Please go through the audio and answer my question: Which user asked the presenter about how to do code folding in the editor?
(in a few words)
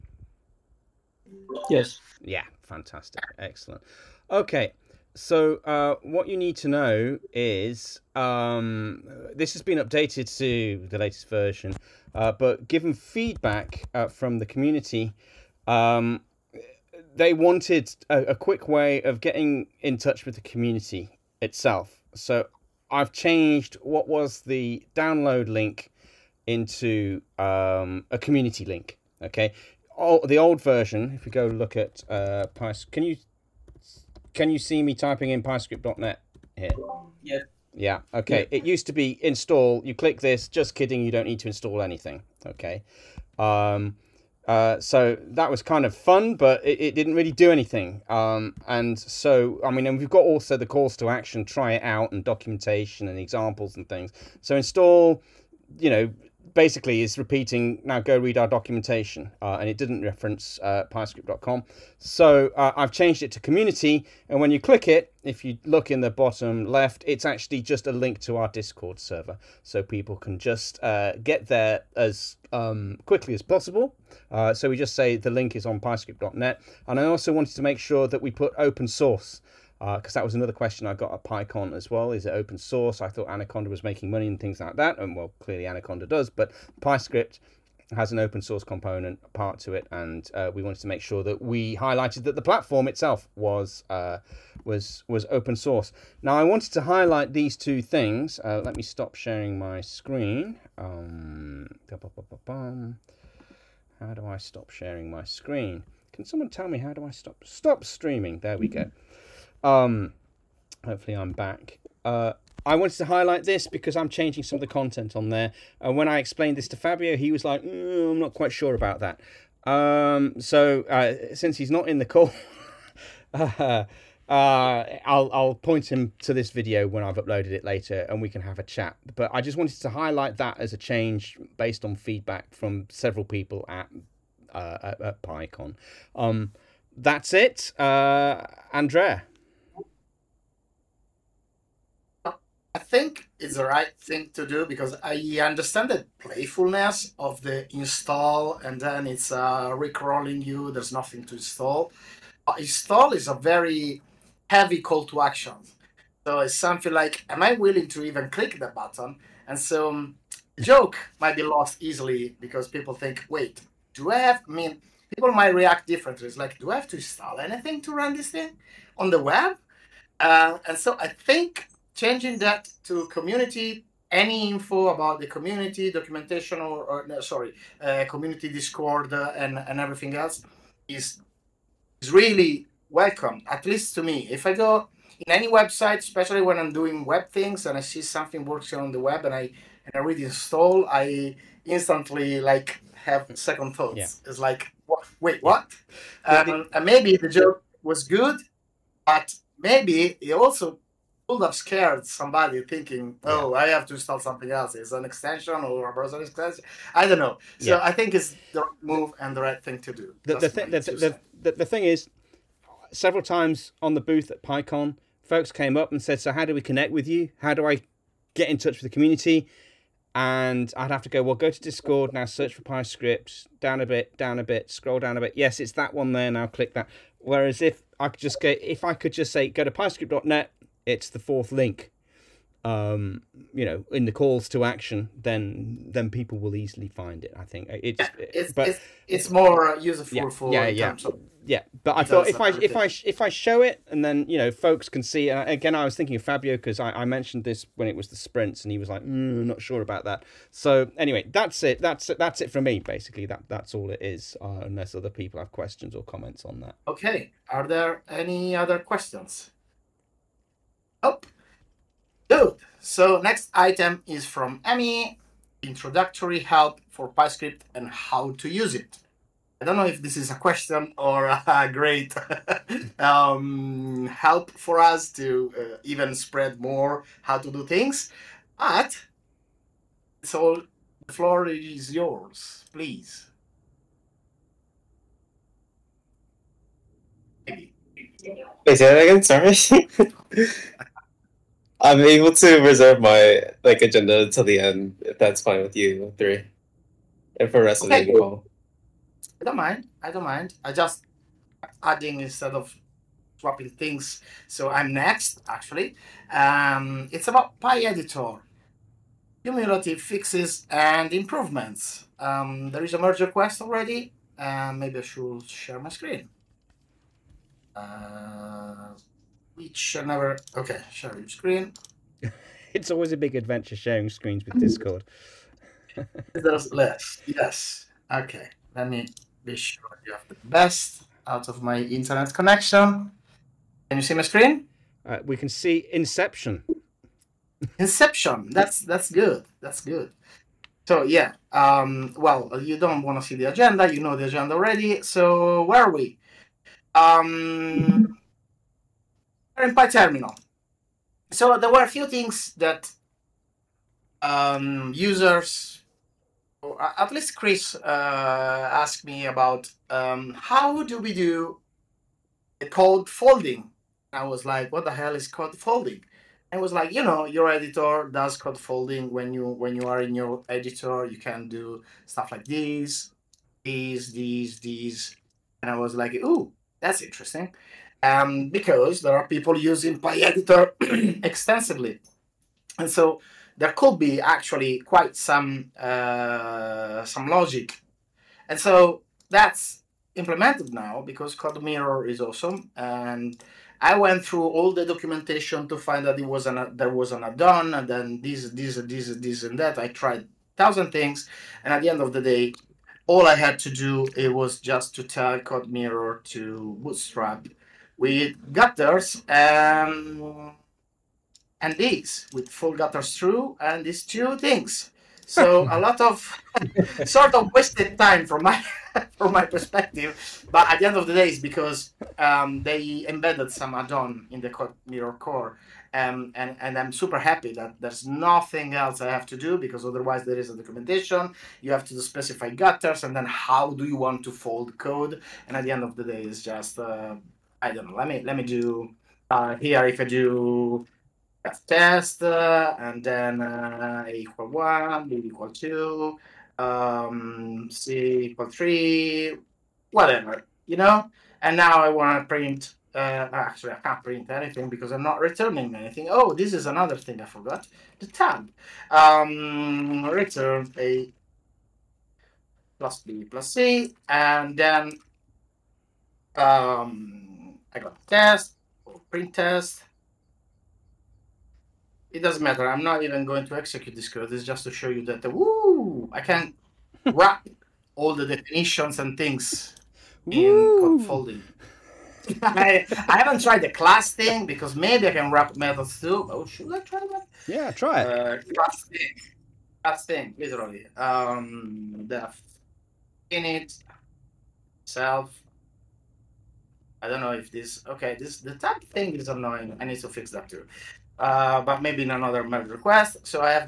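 Chris.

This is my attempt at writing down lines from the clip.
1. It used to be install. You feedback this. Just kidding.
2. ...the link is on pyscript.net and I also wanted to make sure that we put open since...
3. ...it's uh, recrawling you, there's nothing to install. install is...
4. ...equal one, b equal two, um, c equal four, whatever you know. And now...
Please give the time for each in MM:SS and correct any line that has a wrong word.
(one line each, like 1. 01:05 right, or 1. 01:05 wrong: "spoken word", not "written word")
1. 00:38 wrong: "click", not "feedback"
2. 01:15 wrong: "source", not "since"
3. 02:29 right
4. 07:24 wrong: "three", not "four".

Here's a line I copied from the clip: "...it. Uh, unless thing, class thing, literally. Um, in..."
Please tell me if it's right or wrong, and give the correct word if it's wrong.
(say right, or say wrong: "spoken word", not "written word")
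wrong: "class", not "unless".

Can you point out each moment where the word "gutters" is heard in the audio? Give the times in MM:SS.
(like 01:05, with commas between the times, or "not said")
06:48, 06:52, 07:12.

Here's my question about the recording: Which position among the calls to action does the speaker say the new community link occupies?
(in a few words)
fourth.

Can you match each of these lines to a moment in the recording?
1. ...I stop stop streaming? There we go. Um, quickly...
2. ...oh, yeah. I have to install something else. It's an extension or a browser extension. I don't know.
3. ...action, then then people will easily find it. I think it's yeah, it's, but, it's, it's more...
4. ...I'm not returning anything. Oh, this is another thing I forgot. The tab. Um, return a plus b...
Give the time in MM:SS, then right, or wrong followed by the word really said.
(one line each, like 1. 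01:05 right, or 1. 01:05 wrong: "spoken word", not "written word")
1. 01:47 wrong: "hopefully", not "quickly"
2. 03:23 right
3. 03:54 right
4. 07:34 right.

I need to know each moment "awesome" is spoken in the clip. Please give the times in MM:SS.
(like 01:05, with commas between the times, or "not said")
06:32.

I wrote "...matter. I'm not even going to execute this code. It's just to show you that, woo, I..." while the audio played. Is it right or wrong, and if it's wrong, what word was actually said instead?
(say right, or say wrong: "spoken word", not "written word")
right.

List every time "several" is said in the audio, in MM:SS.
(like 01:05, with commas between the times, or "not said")
02:12, 03:32.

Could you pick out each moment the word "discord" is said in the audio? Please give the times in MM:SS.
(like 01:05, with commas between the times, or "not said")
01:08, 02:58, 03:41, 05:24.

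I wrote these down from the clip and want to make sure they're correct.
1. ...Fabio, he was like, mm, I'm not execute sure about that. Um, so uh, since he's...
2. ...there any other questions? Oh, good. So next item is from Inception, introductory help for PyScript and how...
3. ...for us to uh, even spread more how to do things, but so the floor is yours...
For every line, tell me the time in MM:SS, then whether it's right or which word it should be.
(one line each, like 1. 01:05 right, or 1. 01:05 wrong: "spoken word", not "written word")
1. 01:56 wrong: "quite", not "execute"
2. 04:17 wrong: "Emmy", not "Inception"
3. 04:34 right.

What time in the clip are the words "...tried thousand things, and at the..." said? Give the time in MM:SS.
06:39.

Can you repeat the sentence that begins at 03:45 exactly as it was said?
Yes, it's that one there now, click that.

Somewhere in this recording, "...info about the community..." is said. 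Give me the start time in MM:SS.
02:54.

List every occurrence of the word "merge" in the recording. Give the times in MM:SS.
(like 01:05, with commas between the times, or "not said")
05:12, 08:22.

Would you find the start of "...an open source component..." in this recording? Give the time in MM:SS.
01:28.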